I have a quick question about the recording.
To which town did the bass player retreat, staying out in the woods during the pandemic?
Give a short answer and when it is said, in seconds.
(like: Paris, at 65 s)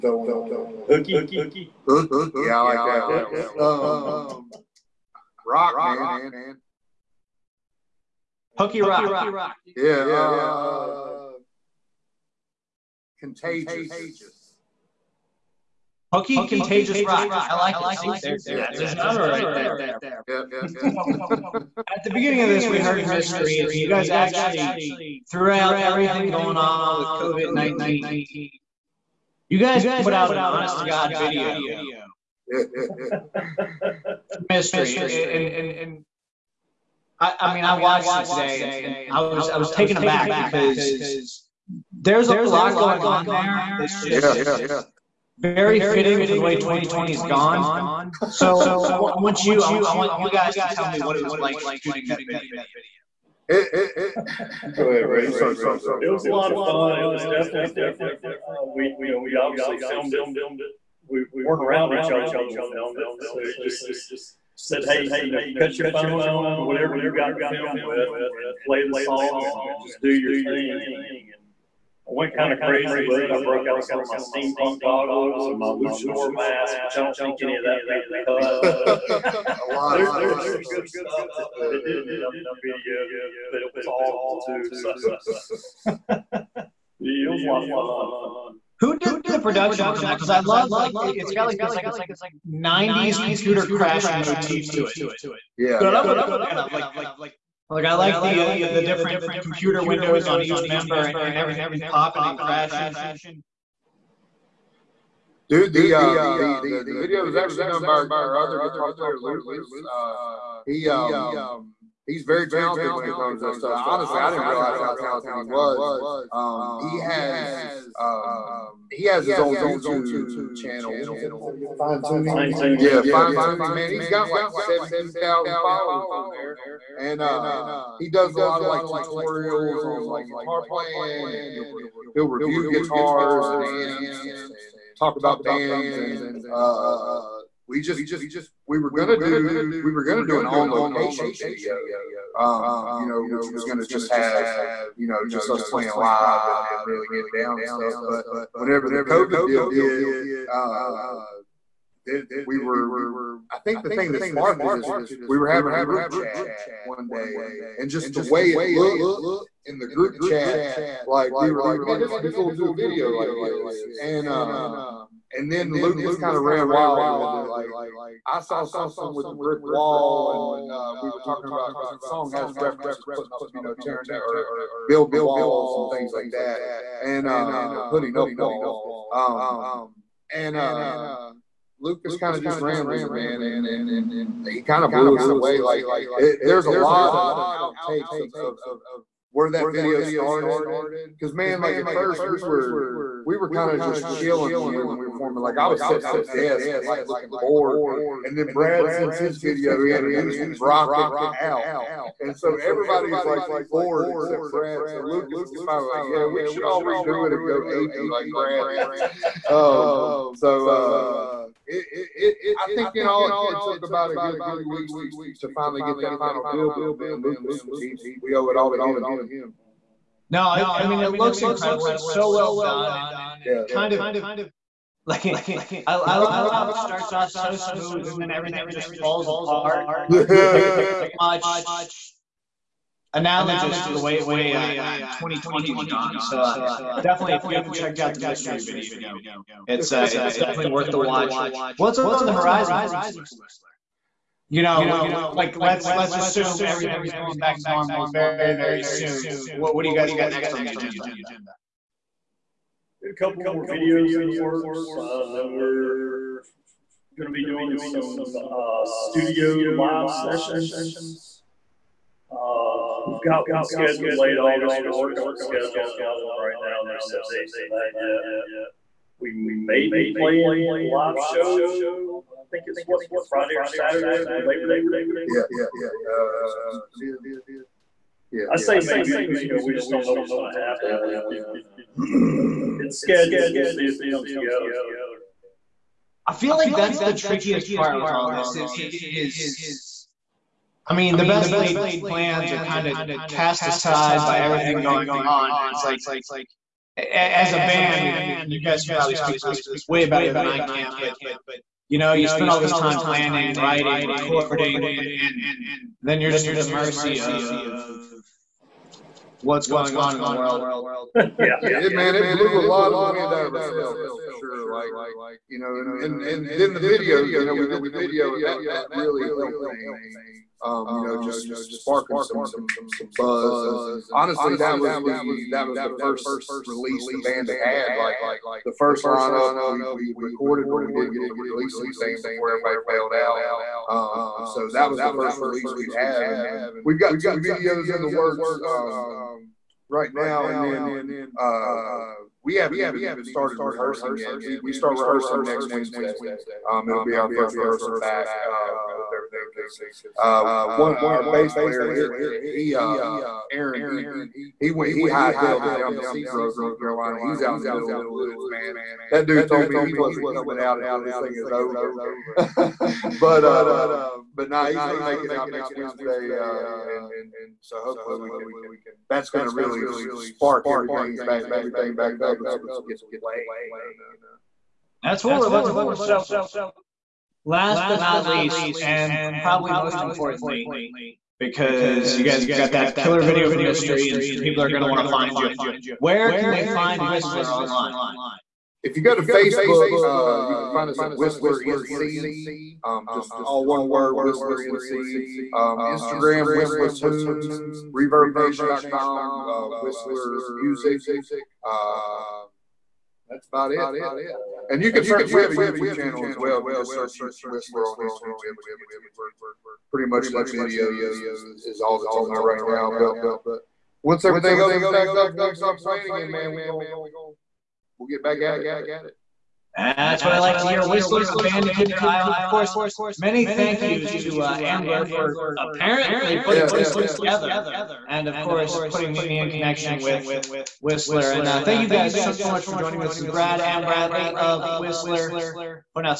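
Seagrove, North Carolina, at 356 s.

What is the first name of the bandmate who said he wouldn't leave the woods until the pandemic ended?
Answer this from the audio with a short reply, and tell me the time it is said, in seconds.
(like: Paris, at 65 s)
Aaron, at 353 s.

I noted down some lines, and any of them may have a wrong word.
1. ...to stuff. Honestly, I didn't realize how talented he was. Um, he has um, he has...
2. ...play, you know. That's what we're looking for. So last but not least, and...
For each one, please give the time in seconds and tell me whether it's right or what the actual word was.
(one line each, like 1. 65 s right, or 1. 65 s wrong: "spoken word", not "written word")
1. 113 s right
2. 373 s right.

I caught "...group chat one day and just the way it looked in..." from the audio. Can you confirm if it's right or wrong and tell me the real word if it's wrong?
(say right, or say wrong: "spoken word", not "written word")
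right.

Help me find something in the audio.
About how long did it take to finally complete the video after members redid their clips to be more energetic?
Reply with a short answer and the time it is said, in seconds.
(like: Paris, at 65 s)
3 weeks, at 214 s.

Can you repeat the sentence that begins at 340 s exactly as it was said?
And then uh, we haven't even started rehearsing yet.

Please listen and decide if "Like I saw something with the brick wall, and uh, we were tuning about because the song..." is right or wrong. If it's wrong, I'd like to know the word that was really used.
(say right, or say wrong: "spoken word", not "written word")
wrong: "talking", not "tuning".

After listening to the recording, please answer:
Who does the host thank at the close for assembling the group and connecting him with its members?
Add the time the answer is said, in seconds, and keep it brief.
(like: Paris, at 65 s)
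Ambler, at 424 s.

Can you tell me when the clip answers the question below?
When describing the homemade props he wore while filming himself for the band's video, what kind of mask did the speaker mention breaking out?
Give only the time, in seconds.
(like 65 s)
75 s.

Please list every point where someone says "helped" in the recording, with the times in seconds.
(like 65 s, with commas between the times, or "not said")
319 s.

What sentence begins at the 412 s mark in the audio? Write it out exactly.
But once everything opens back up and we start playing again, man, we going we'll get back at it.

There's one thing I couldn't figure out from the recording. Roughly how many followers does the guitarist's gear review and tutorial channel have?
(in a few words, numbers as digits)
17,000.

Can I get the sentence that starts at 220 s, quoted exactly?
No, I, I mean it looks incredible.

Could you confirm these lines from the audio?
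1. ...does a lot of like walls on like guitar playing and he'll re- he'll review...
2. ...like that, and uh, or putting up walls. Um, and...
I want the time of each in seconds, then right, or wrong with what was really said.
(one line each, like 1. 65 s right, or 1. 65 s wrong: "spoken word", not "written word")
1. 128 s wrong: "tutorials", not "walls"
2. 176 s right.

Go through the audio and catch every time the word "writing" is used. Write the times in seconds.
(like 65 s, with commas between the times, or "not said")
303 s.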